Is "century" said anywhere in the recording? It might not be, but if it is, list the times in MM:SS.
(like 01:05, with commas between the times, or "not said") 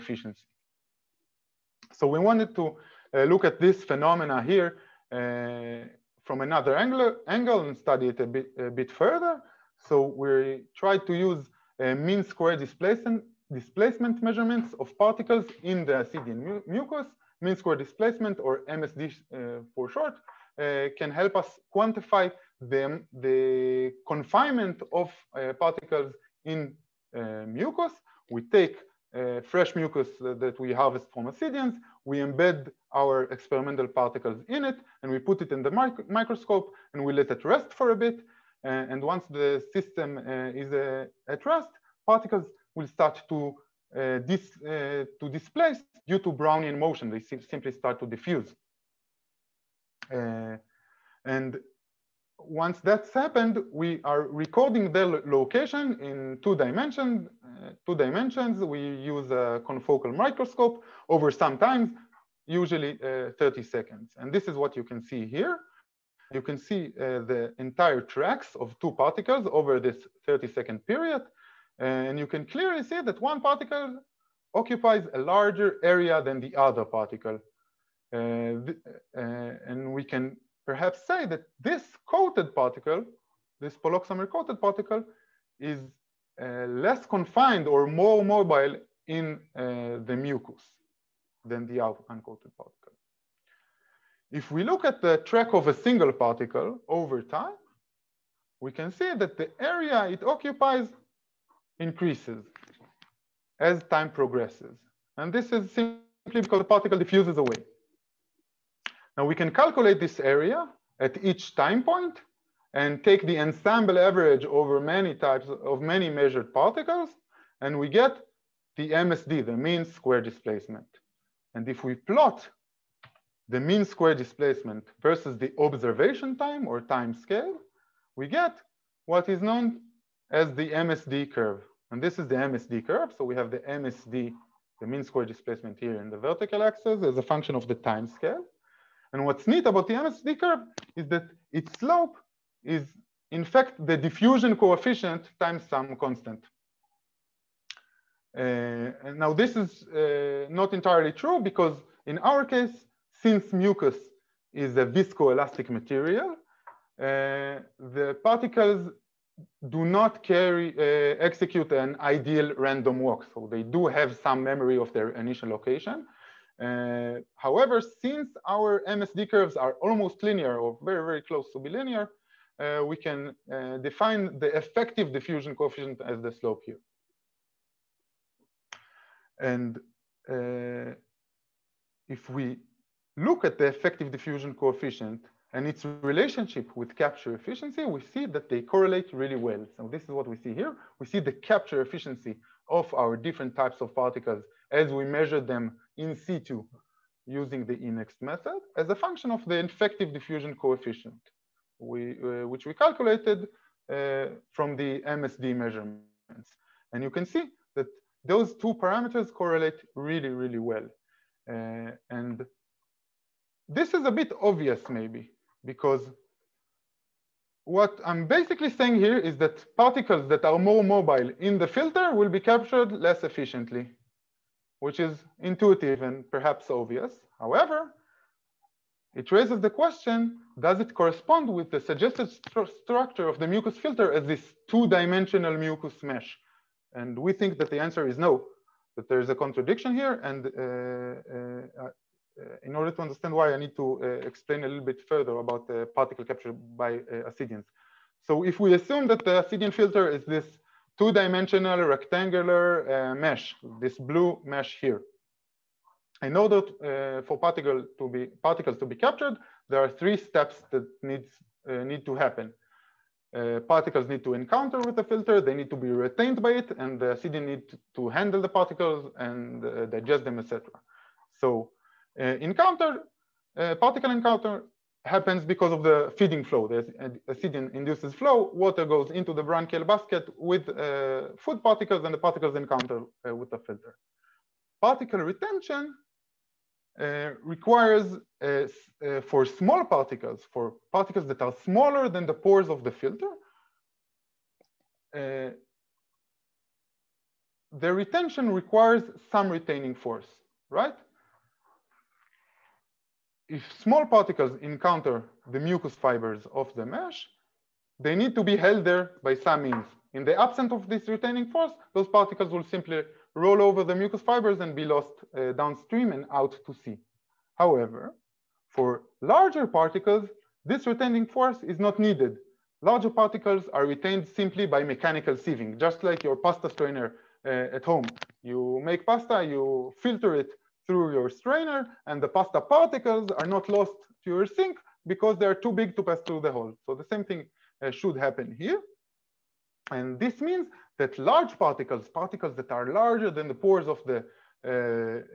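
not said.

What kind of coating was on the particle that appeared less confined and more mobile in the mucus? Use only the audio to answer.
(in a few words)
Poloxamer.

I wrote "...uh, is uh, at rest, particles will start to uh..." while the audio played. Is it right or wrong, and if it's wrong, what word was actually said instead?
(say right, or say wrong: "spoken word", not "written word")
right.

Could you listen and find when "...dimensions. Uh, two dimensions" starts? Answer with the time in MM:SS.
00:56.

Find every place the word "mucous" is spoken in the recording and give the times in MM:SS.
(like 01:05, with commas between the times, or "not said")
05:05, 05:13.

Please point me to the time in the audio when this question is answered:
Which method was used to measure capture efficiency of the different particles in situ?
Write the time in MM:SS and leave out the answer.
03:17.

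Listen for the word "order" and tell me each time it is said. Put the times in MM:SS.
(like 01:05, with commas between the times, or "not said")
04:02, 04:16.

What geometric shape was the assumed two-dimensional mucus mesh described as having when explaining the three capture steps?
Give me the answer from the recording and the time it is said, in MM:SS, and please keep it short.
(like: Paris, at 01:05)
Rectangular, at 04:11.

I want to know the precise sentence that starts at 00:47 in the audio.
They si simply start to diffuse.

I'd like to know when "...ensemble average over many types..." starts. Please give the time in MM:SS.
01:53.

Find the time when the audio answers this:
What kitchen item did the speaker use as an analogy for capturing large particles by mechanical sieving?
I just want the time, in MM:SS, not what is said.
05:26.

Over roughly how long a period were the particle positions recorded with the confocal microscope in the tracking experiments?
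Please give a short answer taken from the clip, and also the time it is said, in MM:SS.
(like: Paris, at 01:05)
30 seconds, at 01:03.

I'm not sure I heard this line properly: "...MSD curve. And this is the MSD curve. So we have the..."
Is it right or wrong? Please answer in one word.
right.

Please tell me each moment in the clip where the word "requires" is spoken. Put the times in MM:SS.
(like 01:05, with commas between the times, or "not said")
04:47, 04:58.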